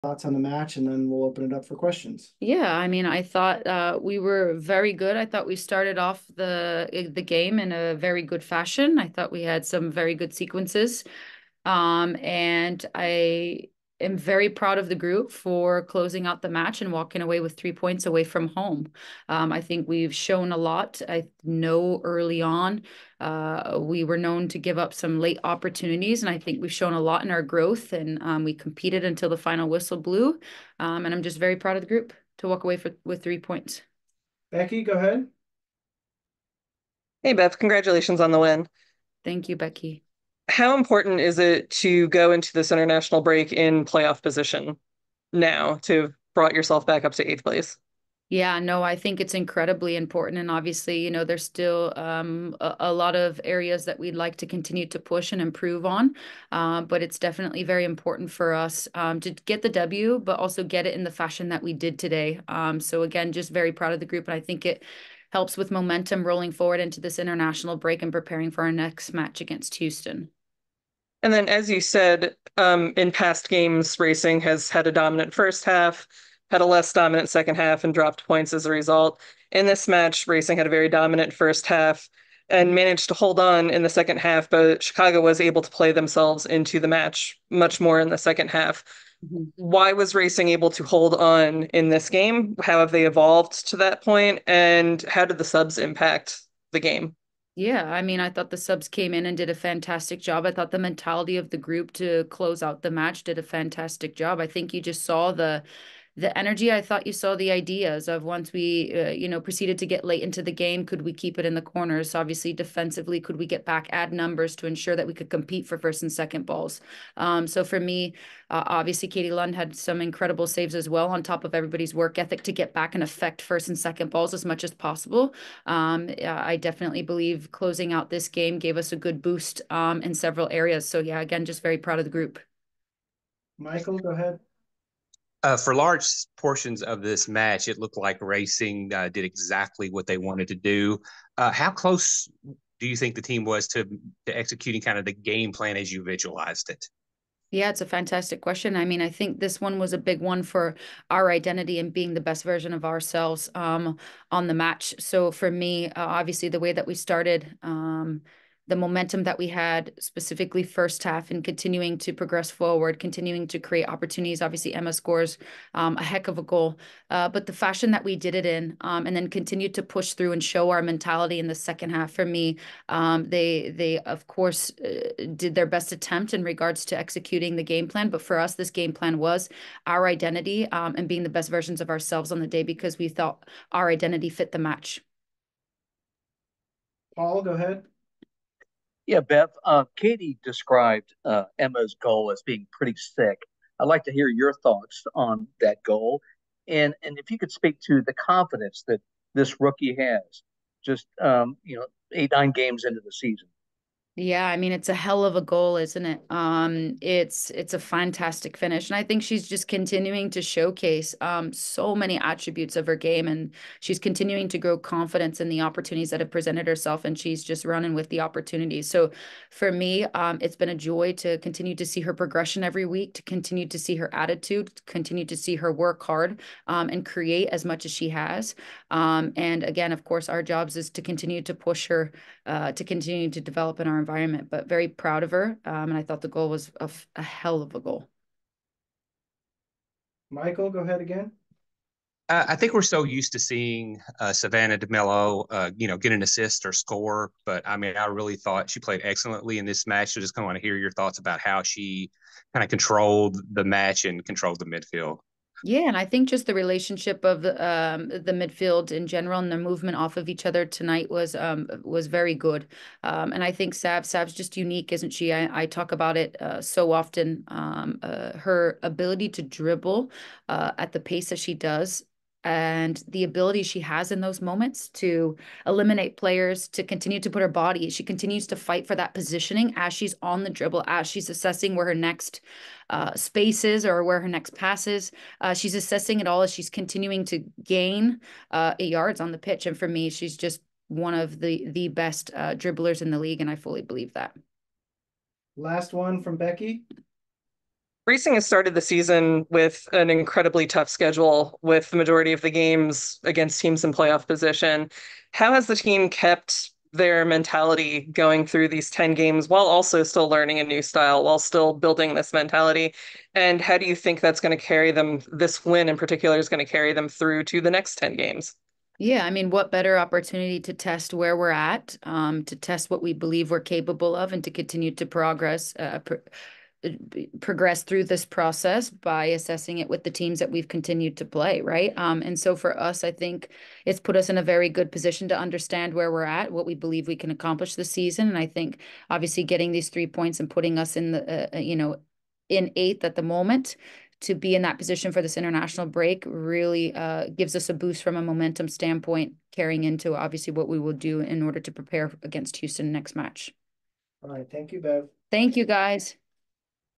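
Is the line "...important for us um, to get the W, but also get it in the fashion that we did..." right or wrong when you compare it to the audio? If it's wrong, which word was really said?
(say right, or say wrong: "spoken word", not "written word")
right.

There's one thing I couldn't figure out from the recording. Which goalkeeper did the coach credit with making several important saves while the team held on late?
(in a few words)
Katie Lund.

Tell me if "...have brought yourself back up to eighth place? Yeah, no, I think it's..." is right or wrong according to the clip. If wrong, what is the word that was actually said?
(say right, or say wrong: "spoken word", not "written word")
right.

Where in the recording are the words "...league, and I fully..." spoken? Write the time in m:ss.
4:53.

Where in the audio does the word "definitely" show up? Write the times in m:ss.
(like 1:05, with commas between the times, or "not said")
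0:57, 2:06.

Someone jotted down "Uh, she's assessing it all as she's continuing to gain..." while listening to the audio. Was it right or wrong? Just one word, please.
right.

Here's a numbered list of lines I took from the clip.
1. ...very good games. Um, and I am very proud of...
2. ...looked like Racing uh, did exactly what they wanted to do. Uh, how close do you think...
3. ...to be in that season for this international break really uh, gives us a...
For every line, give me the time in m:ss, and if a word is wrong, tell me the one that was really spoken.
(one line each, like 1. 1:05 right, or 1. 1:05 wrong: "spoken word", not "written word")
1. 0:09 wrong: "sequences", not "games"
2. 2:17 right
3. 5:44 wrong: "position", not "season".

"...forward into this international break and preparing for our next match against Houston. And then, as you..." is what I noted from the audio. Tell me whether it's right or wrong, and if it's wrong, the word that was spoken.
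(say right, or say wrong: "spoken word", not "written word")
right.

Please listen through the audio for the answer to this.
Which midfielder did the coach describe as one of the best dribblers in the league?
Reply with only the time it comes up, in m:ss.
4:04.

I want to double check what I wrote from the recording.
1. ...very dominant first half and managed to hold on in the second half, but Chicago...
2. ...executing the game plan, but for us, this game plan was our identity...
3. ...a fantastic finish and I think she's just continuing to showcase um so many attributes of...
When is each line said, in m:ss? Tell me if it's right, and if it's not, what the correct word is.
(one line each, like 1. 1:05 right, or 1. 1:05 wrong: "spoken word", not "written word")
1. 1:20 right
2. 2:56 right
3. 3:27 right.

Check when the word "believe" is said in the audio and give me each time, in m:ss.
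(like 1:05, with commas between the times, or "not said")
2:07, 4:53, 5:23, 5:36.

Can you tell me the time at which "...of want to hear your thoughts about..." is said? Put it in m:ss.
4:10.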